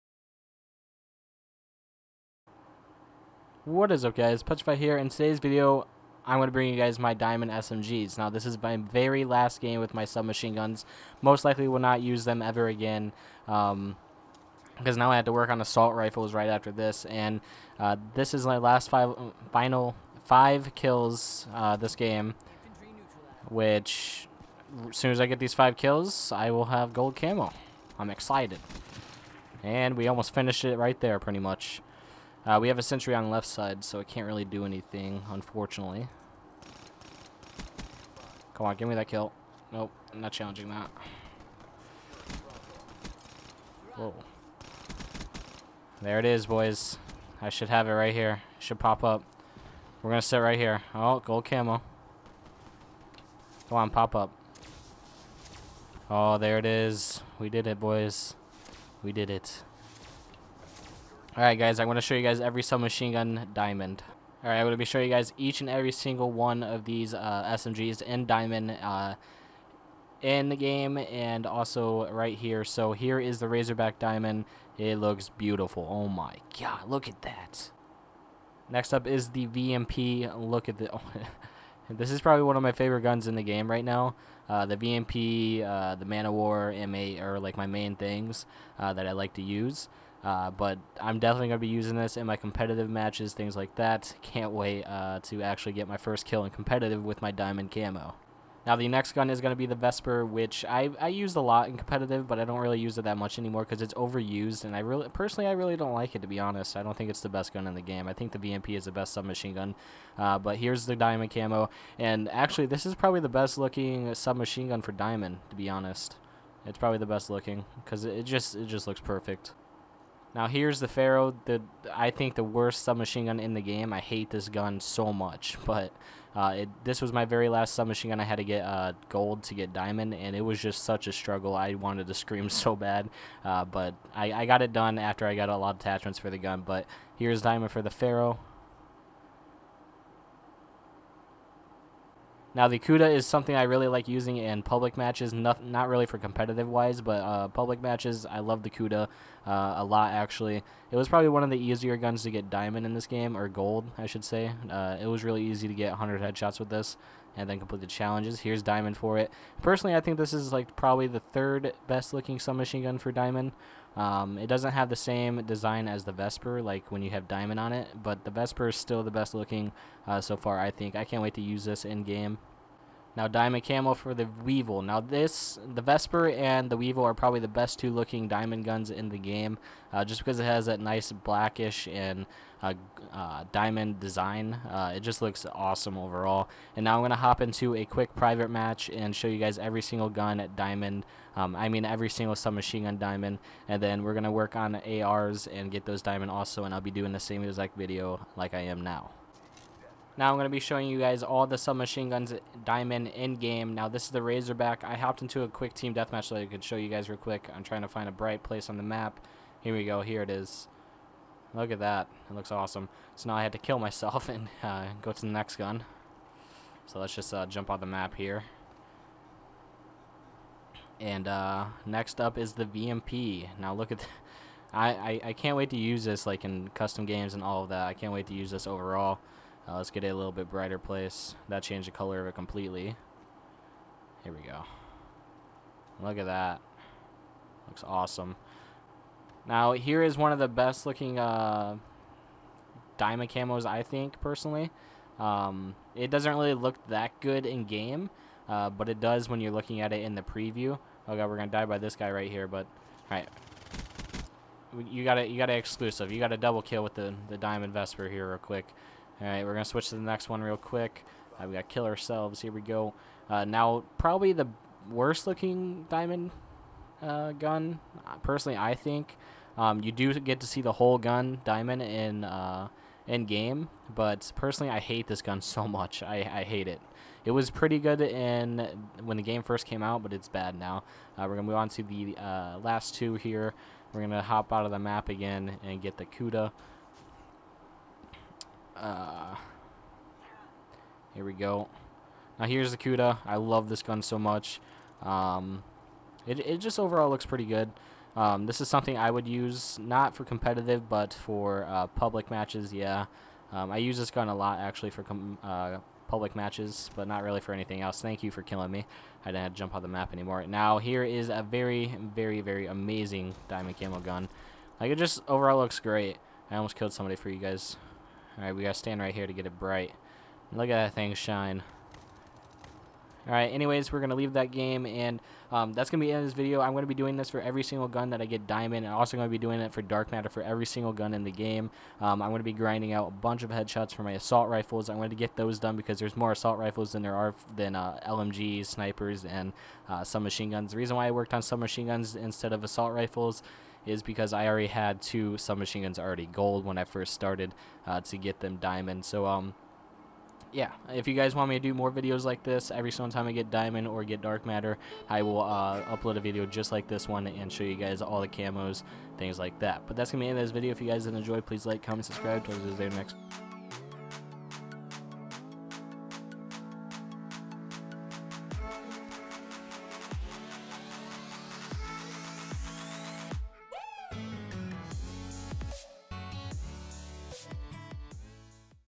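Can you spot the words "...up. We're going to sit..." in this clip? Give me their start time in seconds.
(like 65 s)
49 s.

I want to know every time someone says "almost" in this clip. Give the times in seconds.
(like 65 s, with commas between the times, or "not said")
30 s, 316 s.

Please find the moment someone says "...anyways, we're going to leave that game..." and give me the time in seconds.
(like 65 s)
323 s.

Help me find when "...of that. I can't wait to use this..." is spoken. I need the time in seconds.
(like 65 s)
227 s.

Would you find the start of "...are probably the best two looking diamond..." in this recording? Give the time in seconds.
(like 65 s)
177 s.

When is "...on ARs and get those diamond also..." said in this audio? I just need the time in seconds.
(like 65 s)
194 s.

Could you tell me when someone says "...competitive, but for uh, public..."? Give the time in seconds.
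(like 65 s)
300 s.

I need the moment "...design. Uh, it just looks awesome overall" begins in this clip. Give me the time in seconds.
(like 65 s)
183 s.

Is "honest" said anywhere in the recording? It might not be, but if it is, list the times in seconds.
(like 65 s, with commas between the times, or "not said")
106 s, 115 s.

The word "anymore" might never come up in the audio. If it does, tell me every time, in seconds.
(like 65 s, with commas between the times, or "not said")
103 s, 310 s.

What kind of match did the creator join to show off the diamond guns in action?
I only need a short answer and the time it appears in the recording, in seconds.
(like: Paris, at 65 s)
team deathmatch, at 205 s.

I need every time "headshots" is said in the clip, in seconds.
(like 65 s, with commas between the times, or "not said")
156 s, 333 s.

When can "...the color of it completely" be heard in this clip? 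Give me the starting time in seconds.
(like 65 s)
231 s.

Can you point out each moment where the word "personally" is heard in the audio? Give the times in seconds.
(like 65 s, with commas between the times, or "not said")
105 s, 159 s, 244 s, 268 s, 274 s.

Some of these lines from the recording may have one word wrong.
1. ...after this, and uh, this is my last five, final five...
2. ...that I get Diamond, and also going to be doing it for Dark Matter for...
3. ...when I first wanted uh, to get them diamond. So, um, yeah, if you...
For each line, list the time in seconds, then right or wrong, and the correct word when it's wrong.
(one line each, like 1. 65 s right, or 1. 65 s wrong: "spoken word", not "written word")
1. 16 s right
2. 328 s right
3. 346 s wrong: "started", not "wanted".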